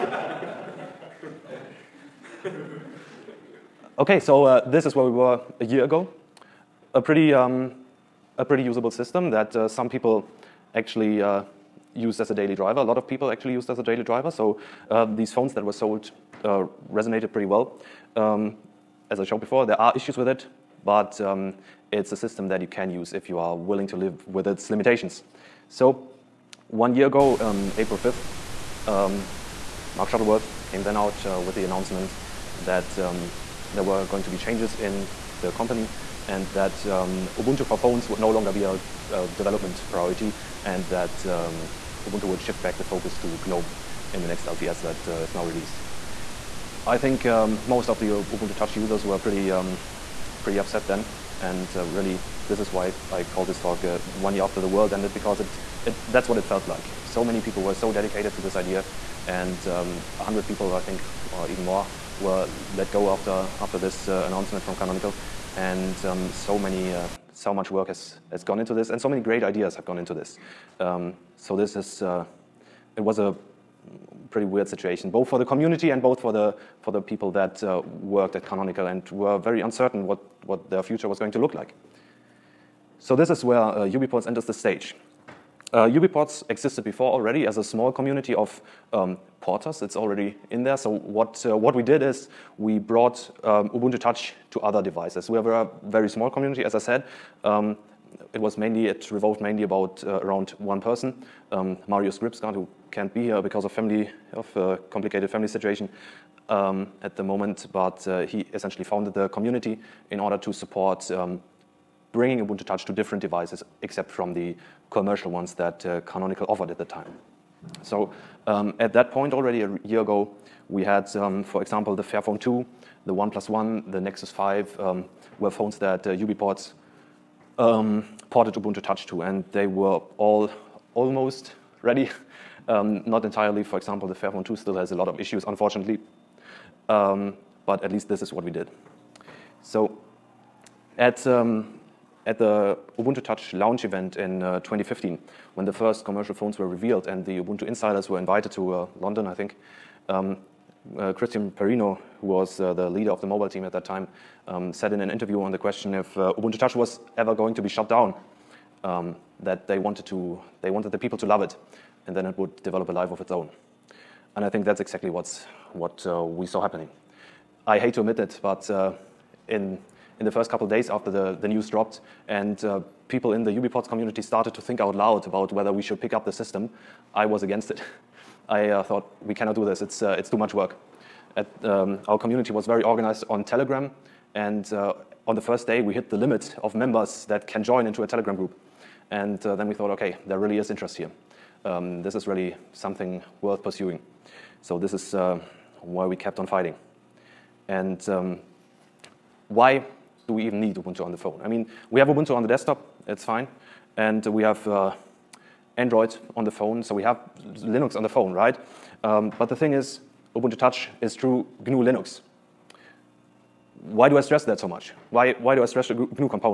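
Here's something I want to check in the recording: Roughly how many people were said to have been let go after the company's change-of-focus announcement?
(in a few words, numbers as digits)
100.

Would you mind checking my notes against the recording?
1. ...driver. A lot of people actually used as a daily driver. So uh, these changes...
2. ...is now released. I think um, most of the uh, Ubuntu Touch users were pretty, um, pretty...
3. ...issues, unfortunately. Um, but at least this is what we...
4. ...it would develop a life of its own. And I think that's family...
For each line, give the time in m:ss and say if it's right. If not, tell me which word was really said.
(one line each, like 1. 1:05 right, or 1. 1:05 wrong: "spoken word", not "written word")
1. 0:12 wrong: "phones", not "changes"
2. 0:45 right
3. 2:15 right
4. 2:42 wrong: "exactly", not "family".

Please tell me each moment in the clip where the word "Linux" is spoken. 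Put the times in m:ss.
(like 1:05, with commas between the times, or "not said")
3:27, 3:31.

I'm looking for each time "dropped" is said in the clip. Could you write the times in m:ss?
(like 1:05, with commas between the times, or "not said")
2:51.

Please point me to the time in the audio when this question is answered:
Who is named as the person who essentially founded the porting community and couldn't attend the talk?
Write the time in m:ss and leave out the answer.
1:41.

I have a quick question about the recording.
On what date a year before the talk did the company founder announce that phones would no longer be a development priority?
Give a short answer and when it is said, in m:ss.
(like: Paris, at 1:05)
April 5th, at 0:27.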